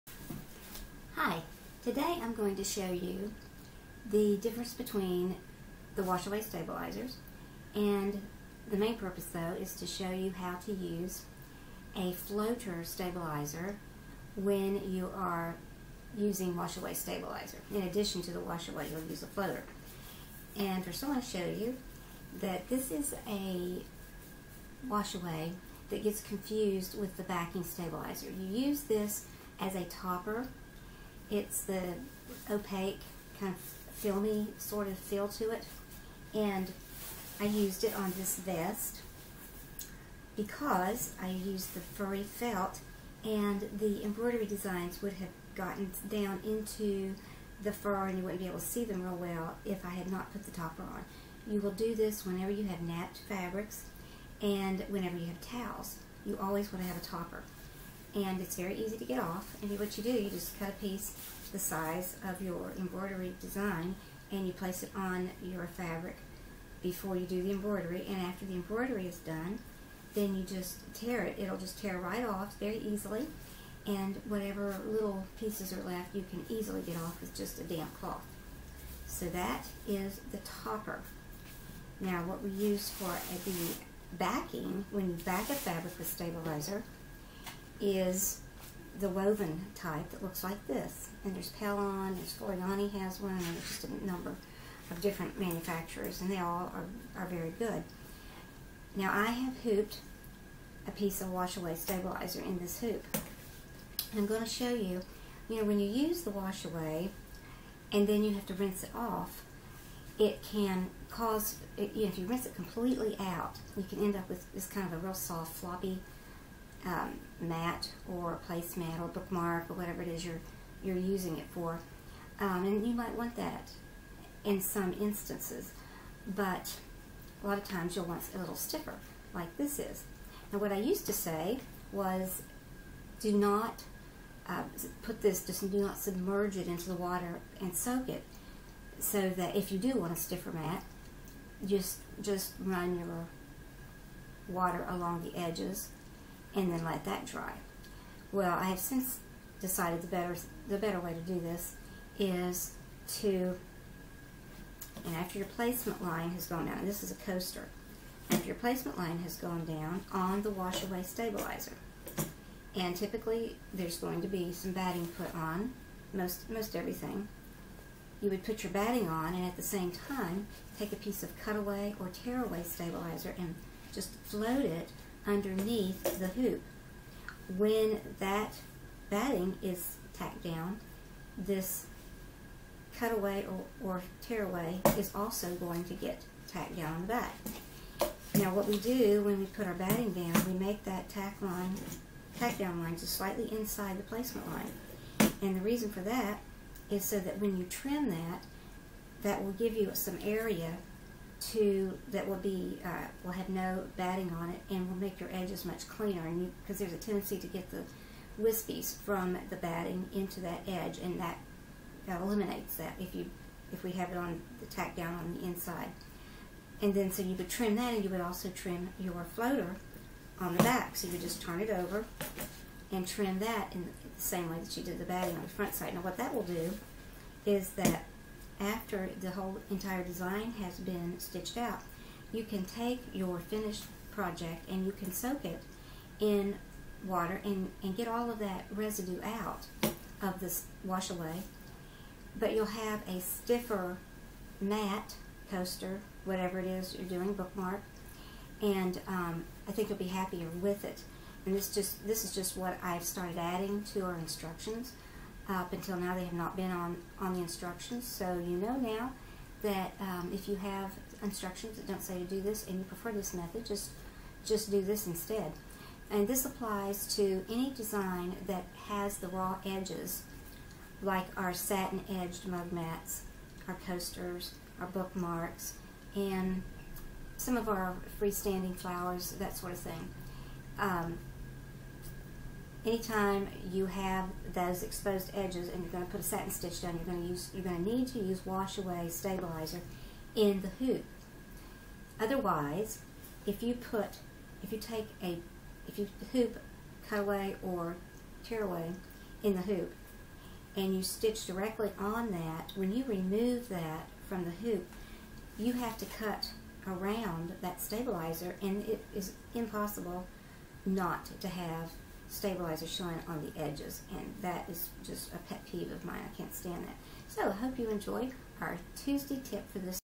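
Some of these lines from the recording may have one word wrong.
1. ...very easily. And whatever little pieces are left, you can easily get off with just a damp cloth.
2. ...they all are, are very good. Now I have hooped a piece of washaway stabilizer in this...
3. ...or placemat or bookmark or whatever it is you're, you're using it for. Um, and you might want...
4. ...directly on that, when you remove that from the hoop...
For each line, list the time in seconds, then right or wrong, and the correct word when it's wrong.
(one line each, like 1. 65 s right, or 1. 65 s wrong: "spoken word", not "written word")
1. 72 s right
2. 96 s right
3. 118 s right
4. 301 s right.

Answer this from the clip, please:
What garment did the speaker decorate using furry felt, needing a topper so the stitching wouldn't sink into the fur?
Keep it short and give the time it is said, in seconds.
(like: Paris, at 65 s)
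vest, at 38 s.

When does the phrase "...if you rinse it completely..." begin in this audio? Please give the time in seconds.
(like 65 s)
112 s.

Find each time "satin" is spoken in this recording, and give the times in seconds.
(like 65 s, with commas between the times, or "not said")
271 s, 286 s.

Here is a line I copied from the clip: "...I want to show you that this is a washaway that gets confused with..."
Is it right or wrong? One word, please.
right.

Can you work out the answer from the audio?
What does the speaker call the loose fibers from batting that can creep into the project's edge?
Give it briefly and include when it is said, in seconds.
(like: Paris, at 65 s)
wispies, at 208 s.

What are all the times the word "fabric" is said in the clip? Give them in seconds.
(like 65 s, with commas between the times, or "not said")
53 s, 65 s, 85 s.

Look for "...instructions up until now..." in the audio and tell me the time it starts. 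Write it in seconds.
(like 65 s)
254 s.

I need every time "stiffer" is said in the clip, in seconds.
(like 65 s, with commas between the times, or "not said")
128 s, 140 s, 243 s.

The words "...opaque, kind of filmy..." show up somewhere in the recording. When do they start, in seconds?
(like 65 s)
32 s.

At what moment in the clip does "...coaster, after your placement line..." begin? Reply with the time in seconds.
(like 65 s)
157 s.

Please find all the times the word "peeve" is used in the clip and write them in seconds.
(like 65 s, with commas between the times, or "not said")
315 s.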